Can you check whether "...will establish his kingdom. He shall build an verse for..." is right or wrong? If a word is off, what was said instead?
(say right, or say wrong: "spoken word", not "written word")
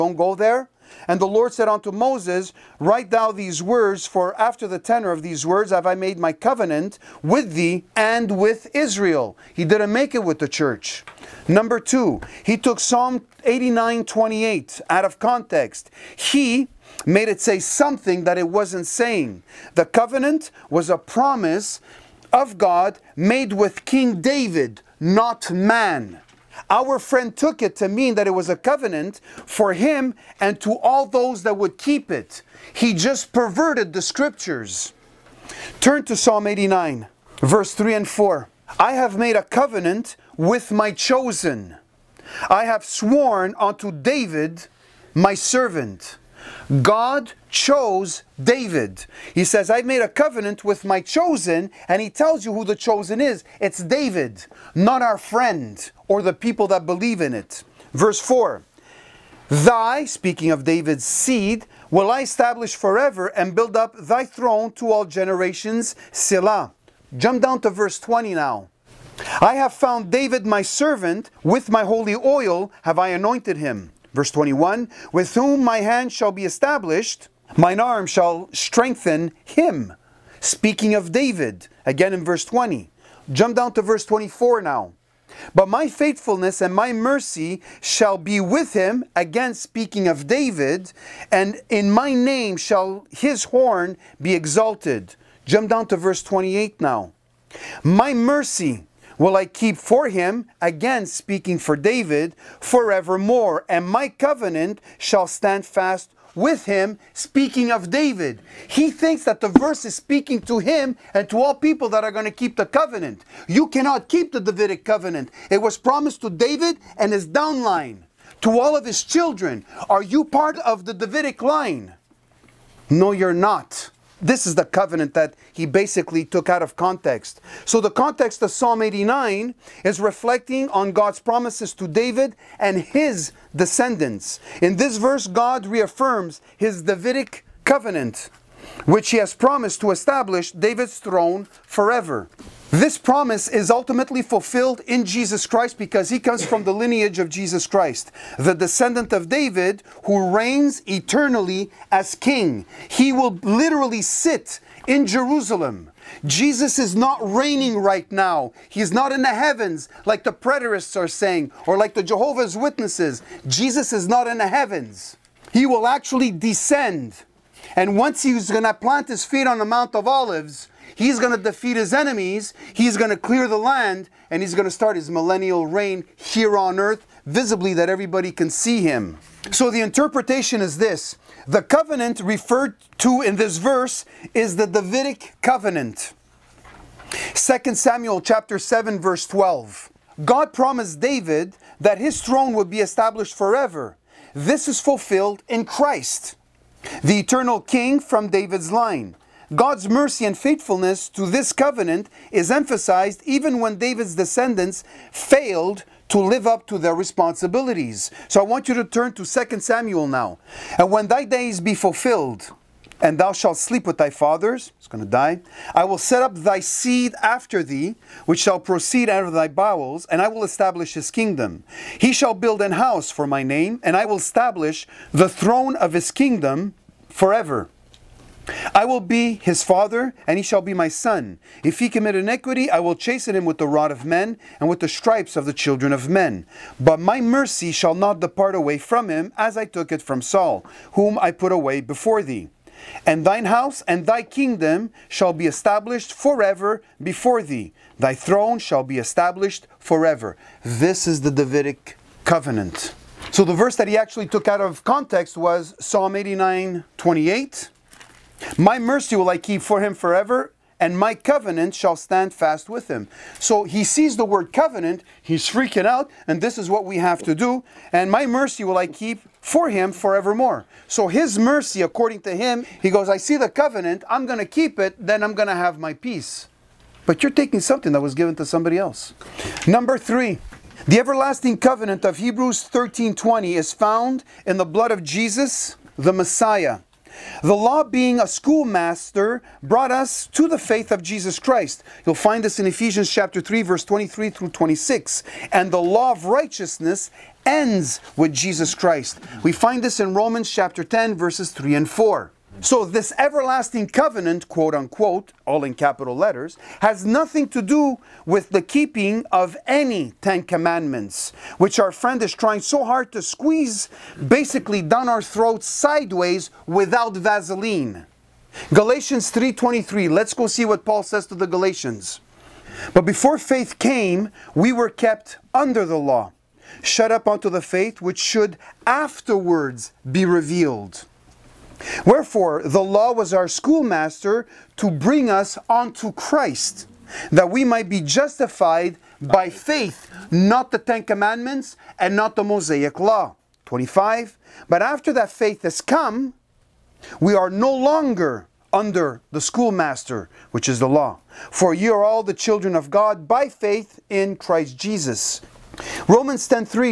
wrong: "house", not "verse".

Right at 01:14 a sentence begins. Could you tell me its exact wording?
Verse 21 With whom my hand shall be established, mine arm shall strengthen him.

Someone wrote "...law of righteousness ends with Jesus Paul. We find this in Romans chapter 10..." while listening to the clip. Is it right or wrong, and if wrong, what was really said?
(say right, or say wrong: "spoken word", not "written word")
wrong: "Christ", not "Paul".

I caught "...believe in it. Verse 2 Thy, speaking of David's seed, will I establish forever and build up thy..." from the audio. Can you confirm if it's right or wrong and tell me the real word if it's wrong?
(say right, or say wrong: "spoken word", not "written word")
wrong: "4", not "2".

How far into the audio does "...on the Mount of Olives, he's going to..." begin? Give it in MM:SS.
02:49.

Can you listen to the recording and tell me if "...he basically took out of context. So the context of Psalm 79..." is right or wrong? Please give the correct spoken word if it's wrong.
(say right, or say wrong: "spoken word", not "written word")
wrong: "89", not "79".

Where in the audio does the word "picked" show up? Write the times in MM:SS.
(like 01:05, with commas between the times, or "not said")
not said.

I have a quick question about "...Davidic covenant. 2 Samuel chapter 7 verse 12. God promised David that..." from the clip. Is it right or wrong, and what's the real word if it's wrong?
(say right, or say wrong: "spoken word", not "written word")
right.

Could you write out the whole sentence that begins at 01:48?
He thinks that the verse is speaking to him and to all people that are going to keep the covenant.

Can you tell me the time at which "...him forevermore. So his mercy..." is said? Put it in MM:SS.
04:29.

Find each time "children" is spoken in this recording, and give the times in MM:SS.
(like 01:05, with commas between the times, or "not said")
01:59, 03:55, 05:52.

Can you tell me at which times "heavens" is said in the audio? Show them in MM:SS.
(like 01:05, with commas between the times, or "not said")
02:39, 02:44.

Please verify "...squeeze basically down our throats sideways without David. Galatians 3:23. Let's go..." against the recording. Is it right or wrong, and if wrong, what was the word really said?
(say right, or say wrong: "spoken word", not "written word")
wrong: "Vaseline", not "David".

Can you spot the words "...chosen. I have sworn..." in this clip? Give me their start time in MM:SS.
00:40.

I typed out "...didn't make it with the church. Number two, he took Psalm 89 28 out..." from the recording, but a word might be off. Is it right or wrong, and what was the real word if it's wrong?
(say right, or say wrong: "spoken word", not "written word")
right.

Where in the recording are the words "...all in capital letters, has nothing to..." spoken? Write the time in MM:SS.
05:05.